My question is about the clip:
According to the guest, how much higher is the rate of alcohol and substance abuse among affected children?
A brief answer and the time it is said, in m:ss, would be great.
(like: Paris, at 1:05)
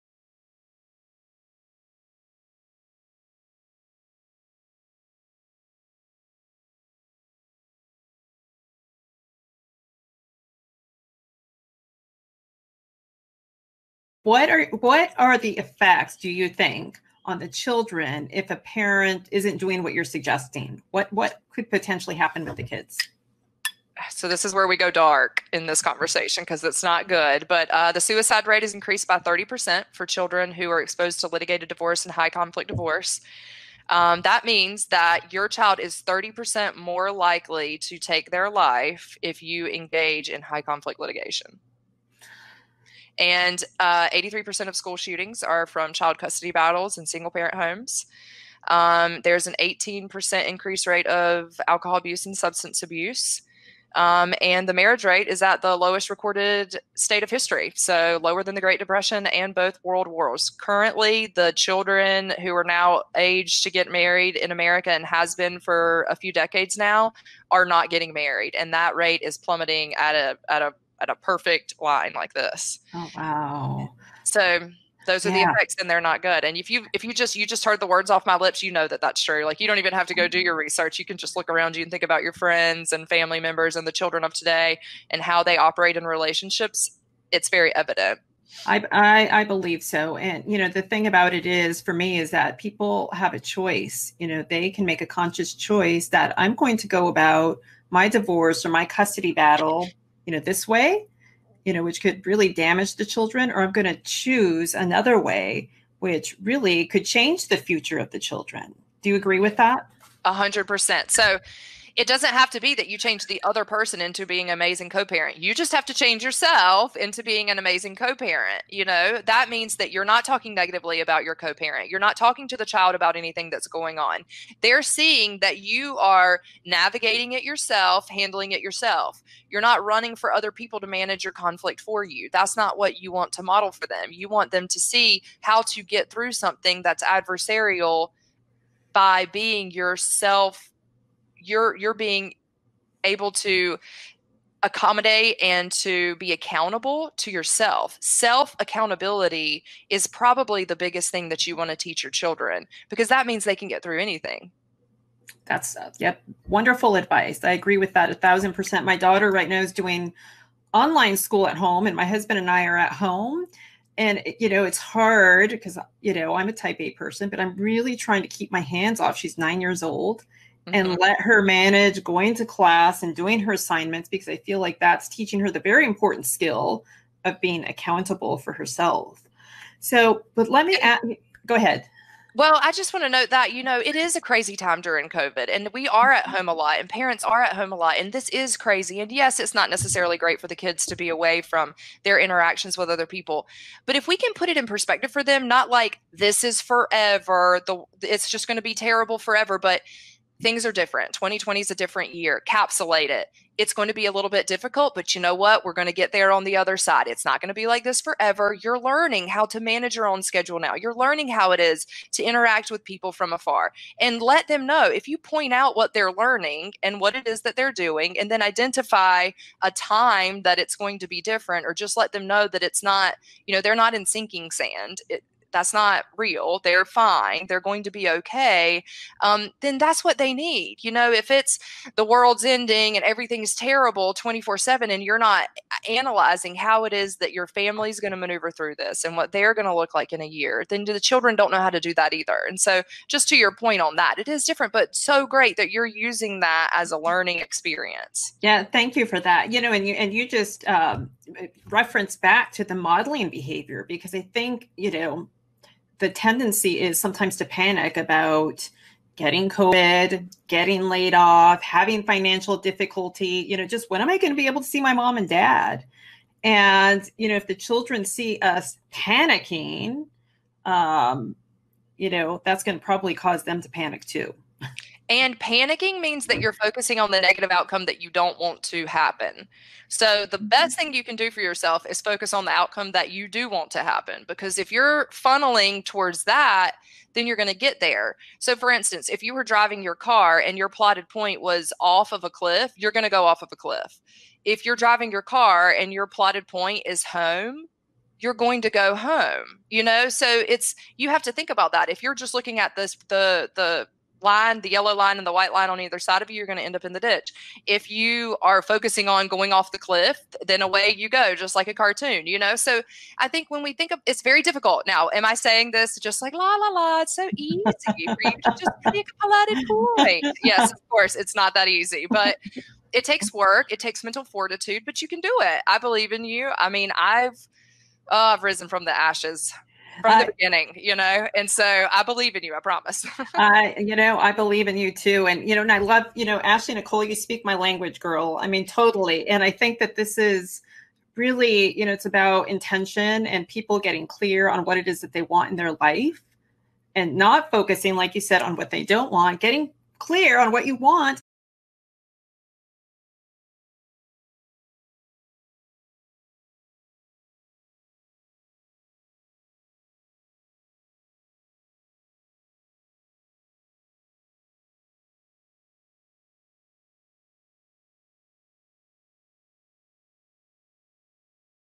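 18%, at 0:49.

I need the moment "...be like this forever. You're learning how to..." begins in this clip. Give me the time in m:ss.
3:27.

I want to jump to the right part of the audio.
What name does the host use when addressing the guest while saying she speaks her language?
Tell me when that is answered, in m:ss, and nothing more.
5:36.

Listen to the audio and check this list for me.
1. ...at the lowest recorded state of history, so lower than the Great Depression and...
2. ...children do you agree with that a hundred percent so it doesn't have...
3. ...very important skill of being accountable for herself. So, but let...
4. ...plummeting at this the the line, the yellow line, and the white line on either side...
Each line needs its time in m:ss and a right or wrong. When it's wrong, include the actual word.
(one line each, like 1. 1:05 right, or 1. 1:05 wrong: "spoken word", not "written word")
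1. 0:55 right
2. 1:48 right
3. 2:55 right
4. 5:02 wrong: "looking", not "plummeting".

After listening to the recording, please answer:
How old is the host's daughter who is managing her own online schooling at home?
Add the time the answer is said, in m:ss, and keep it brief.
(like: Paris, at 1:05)
9, at 2:49.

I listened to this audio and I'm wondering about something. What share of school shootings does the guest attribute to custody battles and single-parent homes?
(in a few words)
83%.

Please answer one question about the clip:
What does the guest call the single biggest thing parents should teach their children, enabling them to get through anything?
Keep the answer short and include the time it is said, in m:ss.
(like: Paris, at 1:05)
Self accountability, at 2:27.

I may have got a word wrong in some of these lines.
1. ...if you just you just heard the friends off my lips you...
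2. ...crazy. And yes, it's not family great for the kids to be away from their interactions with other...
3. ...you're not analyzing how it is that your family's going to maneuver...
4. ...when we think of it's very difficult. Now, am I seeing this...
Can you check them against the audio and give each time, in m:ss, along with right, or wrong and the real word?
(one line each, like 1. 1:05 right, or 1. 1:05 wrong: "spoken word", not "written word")
1. 1:16 wrong: "words", not "friends"
2. 3:08 wrong: "necessarily", not "family"
3. 3:55 right
4. 5:13 wrong: "saying", not "seeing".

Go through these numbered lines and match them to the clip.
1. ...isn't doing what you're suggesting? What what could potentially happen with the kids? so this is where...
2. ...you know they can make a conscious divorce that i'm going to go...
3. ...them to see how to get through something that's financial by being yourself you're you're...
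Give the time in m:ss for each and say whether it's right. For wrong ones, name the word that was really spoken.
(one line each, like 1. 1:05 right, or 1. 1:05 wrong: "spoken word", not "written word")
1. 0:19 right
2. 1:34 wrong: "choice", not "divorce"
3. 2:14 wrong: "adversarial", not "financial".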